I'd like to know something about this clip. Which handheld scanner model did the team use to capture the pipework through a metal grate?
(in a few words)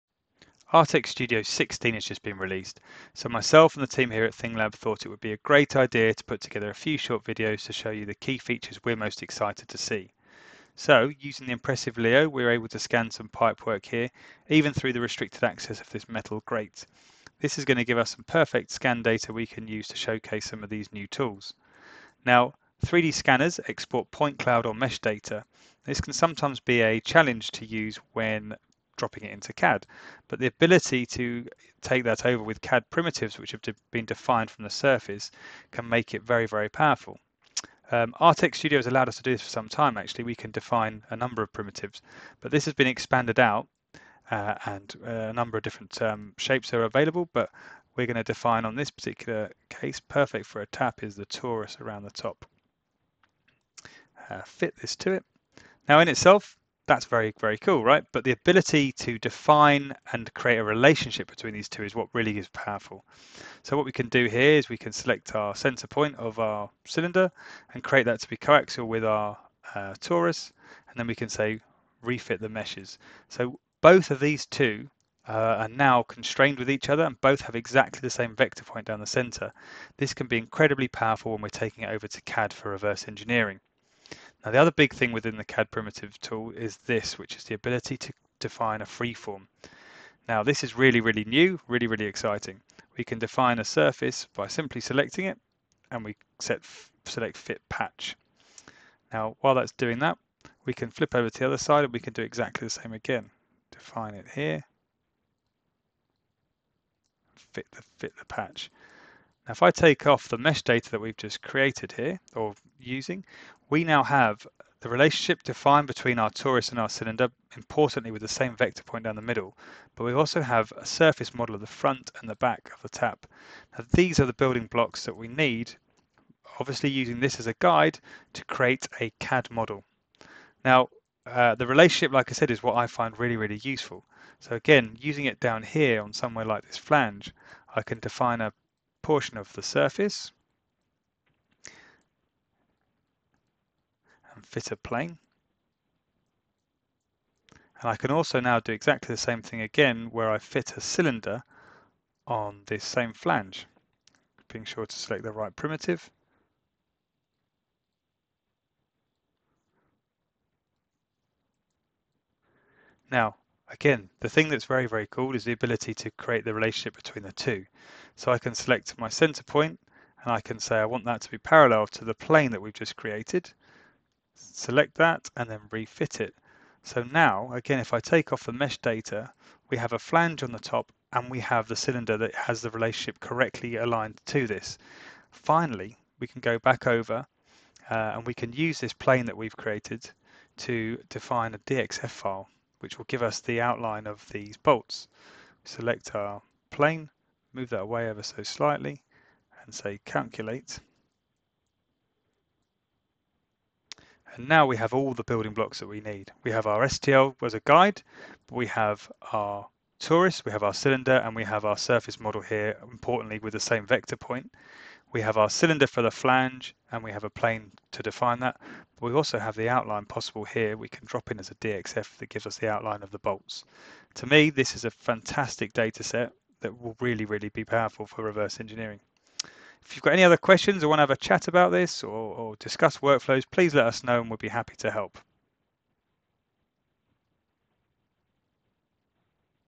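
Leo.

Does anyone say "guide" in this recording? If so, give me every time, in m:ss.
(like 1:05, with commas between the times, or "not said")
2:07, 3:27.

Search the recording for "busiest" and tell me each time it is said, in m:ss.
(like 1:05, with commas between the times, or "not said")
not said.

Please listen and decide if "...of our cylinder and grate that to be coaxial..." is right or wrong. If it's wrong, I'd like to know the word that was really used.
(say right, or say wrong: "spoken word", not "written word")
wrong: "create", not "grate".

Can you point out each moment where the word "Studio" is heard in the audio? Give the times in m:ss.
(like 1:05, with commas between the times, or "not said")
0:01, 0:38.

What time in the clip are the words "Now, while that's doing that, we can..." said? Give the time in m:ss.
1:39.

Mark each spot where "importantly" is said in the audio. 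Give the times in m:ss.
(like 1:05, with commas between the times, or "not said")
1:57, 3:32.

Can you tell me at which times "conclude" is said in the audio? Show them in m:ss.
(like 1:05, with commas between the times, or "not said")
not said.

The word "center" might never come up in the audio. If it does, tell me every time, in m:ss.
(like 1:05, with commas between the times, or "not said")
1:05, 1:19, 2:49.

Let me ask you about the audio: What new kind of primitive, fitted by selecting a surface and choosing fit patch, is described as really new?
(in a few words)
Freeform.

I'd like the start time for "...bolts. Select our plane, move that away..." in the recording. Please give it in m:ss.
3:14.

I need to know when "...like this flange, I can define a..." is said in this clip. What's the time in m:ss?
2:16.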